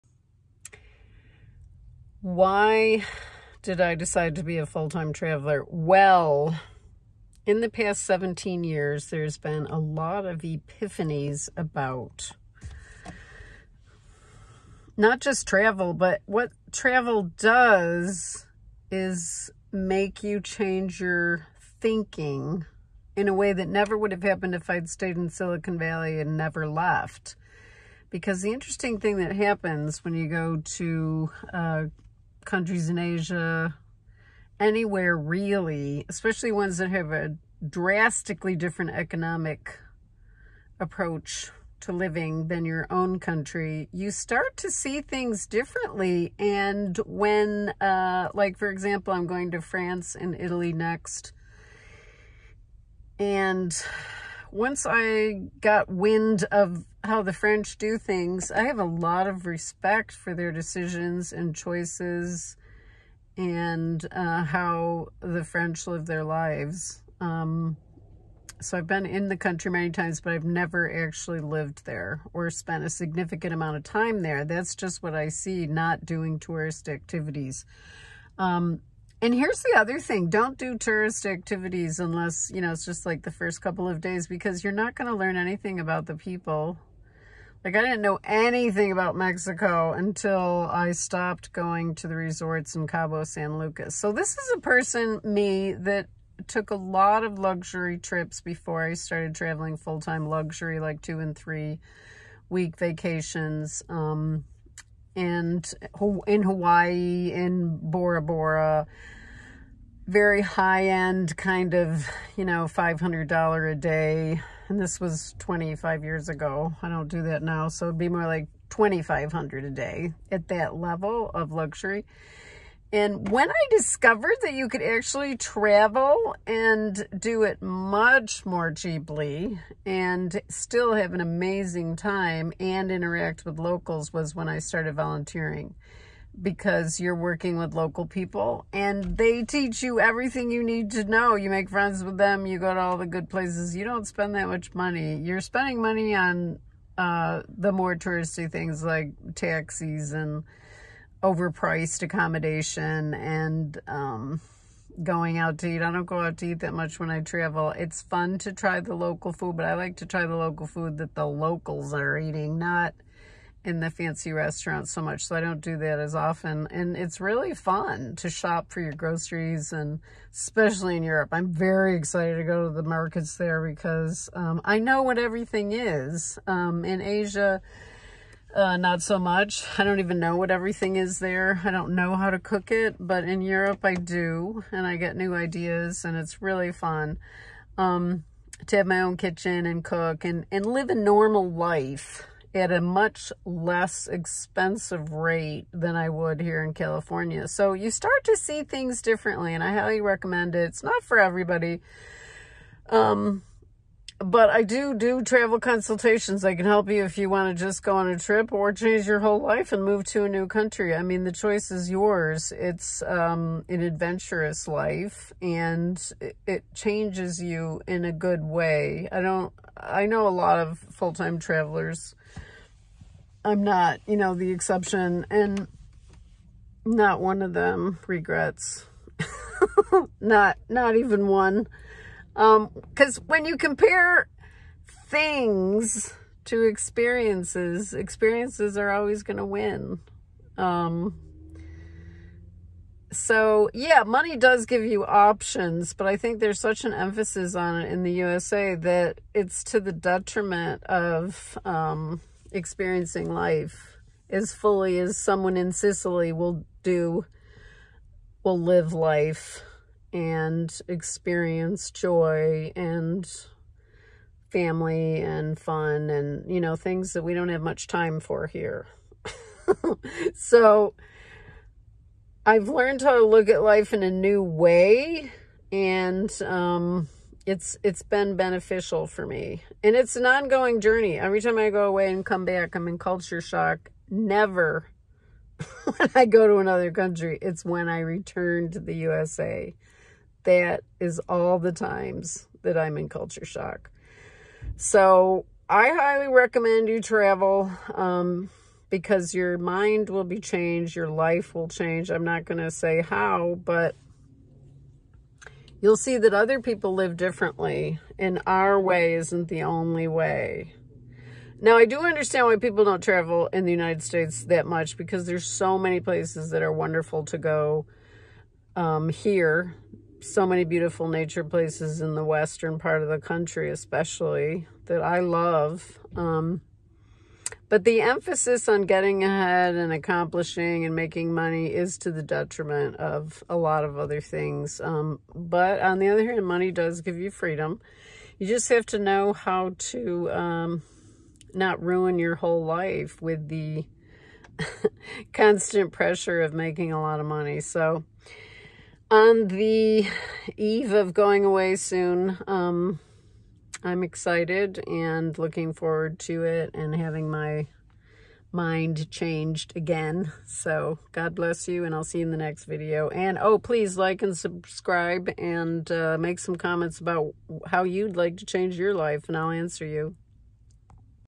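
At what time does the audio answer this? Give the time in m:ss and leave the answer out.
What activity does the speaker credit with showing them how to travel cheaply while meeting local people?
2:14.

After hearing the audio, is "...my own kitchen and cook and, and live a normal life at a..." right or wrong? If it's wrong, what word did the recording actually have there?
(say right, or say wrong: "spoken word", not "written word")
right.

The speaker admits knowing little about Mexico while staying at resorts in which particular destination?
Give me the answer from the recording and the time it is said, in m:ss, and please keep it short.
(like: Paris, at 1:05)
Cabo San Lucas, at 1:32.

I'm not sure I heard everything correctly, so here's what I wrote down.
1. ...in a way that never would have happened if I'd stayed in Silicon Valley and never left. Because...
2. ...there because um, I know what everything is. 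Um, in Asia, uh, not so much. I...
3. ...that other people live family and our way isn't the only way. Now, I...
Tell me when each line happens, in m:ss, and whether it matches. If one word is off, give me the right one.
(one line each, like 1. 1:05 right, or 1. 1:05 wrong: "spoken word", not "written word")
1. 0:23 right
2. 2:53 right
3. 5:06 wrong: "differently", not "family".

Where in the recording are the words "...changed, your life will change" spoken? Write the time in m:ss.
5:00.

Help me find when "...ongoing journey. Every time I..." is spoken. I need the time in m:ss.
4:40.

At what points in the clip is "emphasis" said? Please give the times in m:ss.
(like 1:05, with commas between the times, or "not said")
4:06, 5:28.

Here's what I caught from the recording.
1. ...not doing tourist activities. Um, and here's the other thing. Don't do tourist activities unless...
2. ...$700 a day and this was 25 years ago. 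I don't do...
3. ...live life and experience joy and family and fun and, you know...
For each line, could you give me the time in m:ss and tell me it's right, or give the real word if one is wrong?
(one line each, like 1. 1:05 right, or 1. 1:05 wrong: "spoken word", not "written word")
1. 1:15 right
2. 1:52 wrong: "500", not "700"
3. 4:18 right.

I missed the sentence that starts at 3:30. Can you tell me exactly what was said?
I mean, the choice is yours.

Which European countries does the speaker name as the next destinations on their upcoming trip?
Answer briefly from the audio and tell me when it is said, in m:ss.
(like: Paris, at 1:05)
France and Italy, at 0:49.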